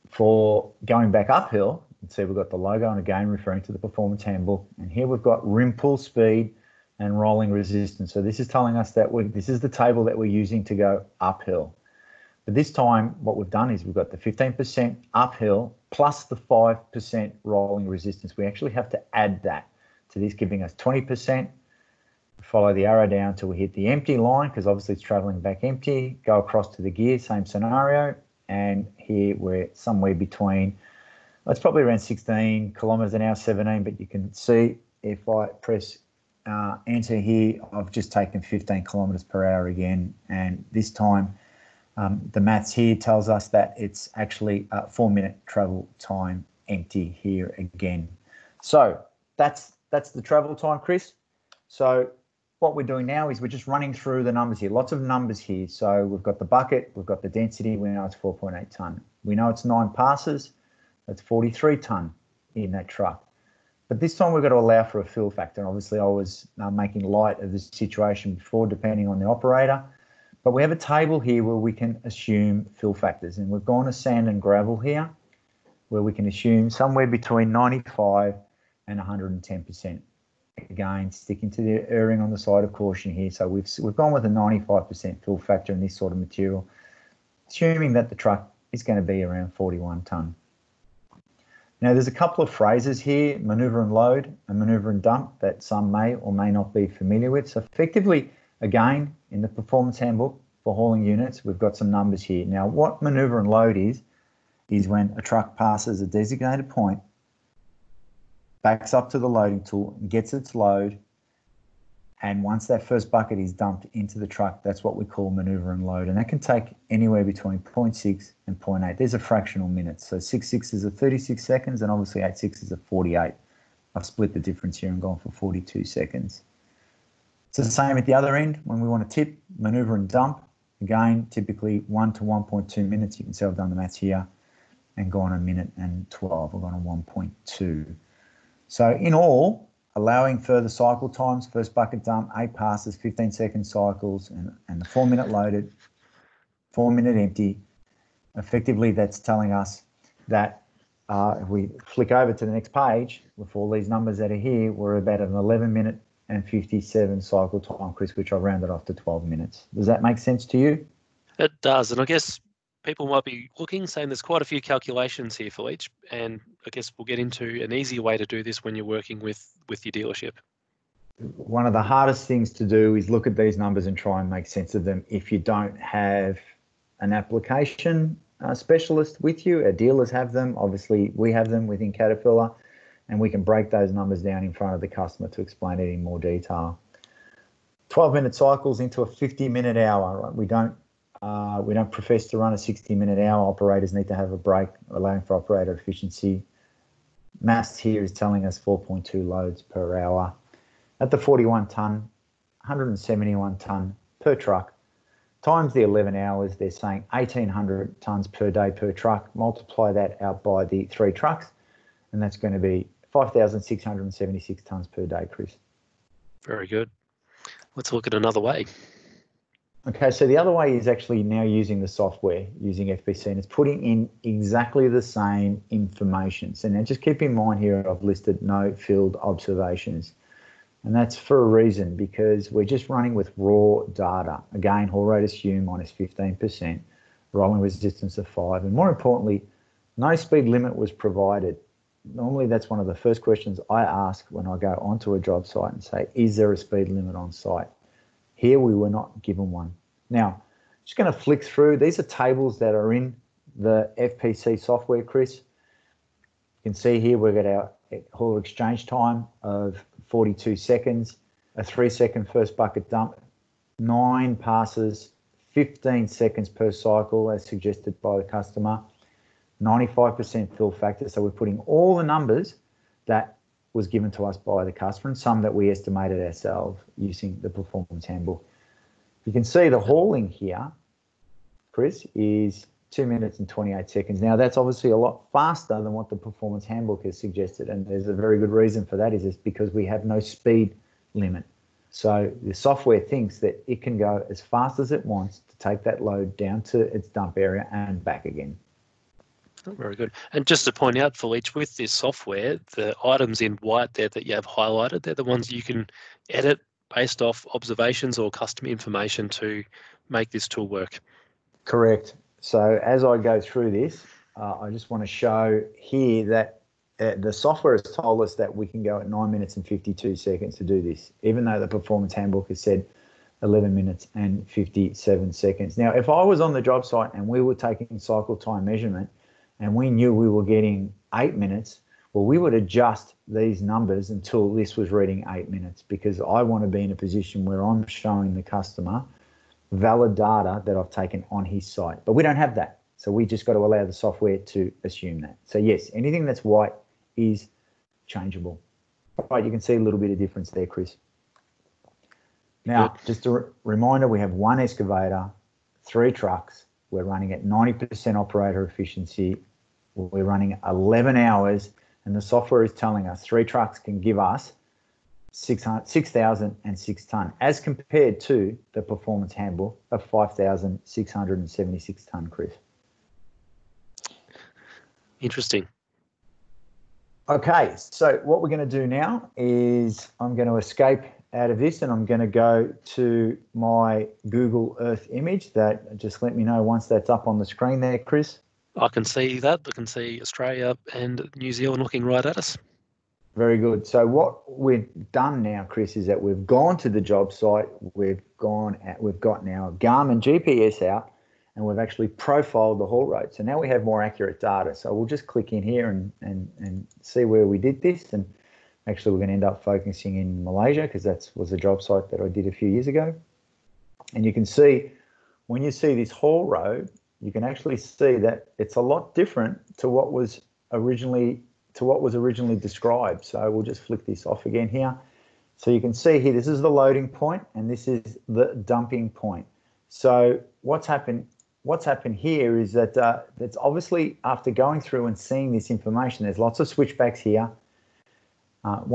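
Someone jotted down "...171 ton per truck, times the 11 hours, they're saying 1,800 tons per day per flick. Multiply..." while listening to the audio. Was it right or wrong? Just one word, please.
wrong.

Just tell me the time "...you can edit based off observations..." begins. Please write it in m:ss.
5:05.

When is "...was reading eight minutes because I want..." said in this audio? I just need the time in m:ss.
5:34.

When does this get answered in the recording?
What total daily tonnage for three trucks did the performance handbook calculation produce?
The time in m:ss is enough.
3:33.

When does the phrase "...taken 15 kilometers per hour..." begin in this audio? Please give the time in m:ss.
0:38.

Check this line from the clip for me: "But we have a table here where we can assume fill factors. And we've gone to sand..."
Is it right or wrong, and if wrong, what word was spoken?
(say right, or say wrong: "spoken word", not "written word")
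right.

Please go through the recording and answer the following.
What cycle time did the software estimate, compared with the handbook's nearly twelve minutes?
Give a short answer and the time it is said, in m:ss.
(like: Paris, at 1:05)
9 minutes 52 seconds, at 5:19.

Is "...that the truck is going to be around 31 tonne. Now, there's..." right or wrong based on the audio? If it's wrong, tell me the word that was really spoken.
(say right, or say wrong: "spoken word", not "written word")
wrong: "41", not "31".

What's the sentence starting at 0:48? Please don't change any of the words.
So that's that's the travel time, Chris.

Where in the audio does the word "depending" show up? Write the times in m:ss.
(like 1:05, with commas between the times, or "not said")
1:08.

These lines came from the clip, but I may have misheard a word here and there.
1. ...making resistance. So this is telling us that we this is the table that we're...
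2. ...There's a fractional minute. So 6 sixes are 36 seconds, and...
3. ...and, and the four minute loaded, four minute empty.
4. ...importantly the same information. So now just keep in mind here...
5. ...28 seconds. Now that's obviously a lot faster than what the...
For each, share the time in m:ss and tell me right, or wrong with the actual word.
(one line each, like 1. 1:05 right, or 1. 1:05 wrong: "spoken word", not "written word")
1. 0:07 wrong: "rolling", not "making"
2. 1:58 right
3. 2:24 right
4. 3:44 wrong: "exactly", not "importantly"
5. 4:43 right.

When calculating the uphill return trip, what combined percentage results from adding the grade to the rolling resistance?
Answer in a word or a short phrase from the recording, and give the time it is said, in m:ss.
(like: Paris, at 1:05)
20%, at 0:20.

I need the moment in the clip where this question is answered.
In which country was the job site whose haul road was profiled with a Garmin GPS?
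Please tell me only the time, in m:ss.
6:50.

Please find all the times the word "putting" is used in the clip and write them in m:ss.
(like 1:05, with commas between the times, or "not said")
3:43, 4:31.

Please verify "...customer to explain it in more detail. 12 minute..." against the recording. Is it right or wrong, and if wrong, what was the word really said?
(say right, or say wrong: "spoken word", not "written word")
right.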